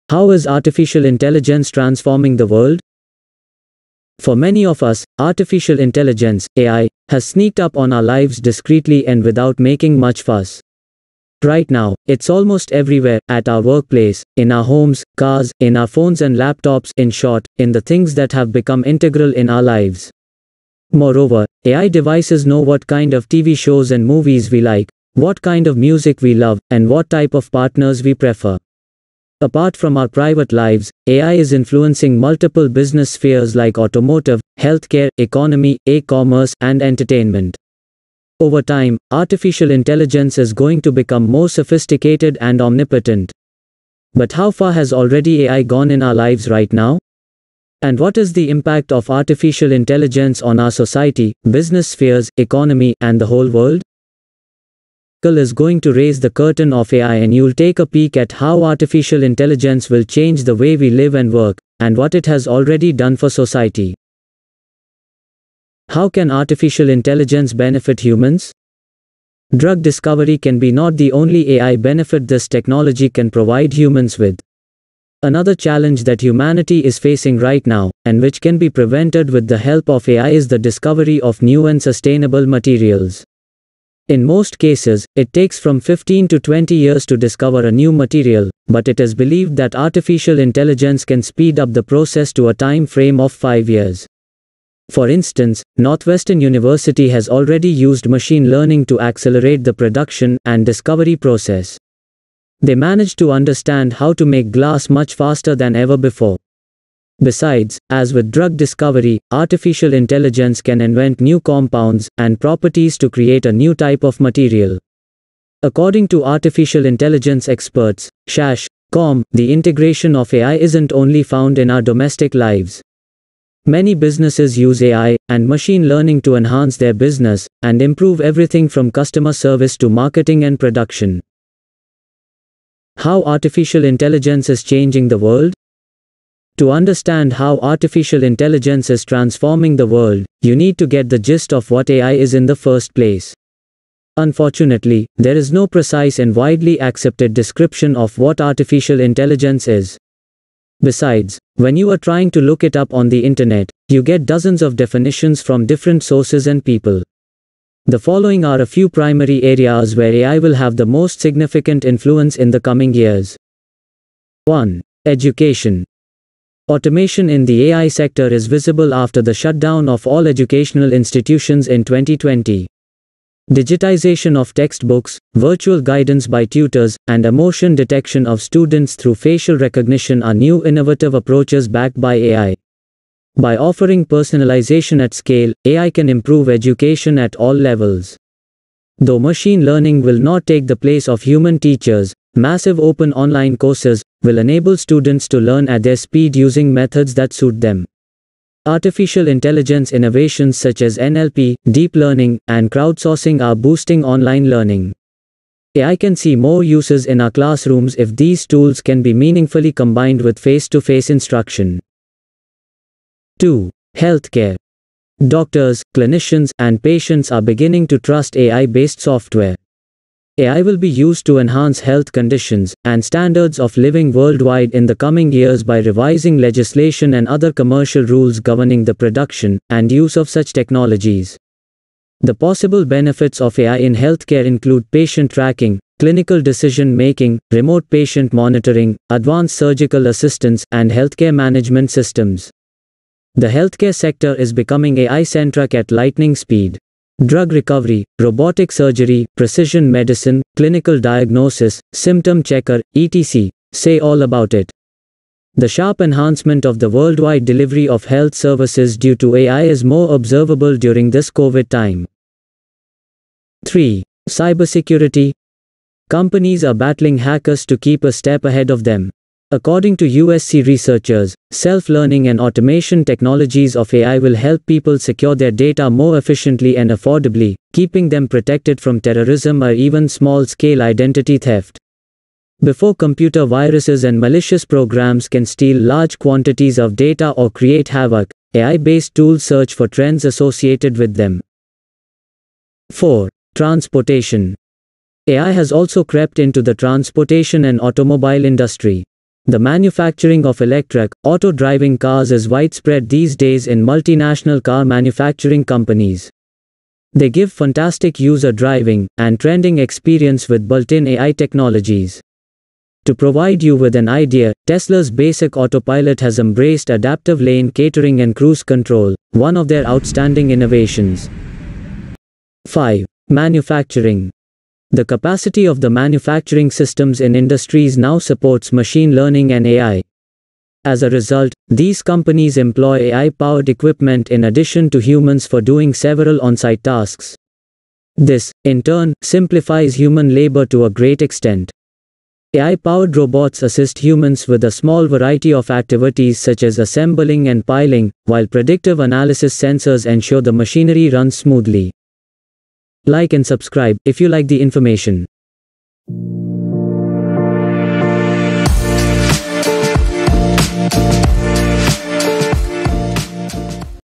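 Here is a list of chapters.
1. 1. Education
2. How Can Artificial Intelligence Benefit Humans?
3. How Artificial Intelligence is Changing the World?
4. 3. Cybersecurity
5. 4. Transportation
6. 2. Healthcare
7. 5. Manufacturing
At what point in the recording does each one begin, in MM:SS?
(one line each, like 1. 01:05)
1. 02:44
2. 01:04
3. 02:11
4. 04:23
5. 04:52
6. 03:32
7. 05:22.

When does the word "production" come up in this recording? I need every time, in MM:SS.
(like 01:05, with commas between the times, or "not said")
01:39, 02:10, 03:48.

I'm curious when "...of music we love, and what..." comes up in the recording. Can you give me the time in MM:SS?
00:25.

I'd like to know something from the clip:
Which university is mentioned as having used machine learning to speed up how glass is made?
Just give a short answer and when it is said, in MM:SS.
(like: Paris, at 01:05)
Northwestern University, at 01:35.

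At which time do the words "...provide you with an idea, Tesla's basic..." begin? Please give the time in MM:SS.
05:13.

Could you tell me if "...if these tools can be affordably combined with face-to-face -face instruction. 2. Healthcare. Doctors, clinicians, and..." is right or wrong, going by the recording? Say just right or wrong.
wrong.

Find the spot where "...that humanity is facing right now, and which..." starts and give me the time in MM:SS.
01:16.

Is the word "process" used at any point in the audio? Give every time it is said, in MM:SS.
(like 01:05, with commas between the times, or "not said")
01:31, 01:41.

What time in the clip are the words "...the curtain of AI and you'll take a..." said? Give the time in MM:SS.
00:56.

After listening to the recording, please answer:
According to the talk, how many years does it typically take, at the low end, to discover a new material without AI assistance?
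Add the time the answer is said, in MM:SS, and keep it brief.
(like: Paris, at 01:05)
15, at 01:25.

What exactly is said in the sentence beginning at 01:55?
According to artificial intelligence experts, Shash, Com, the integration of AI isn't only found in our domestic lives.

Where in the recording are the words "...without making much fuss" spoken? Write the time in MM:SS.
00:09.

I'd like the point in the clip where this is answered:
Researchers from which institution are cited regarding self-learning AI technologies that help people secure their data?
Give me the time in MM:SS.
04:30.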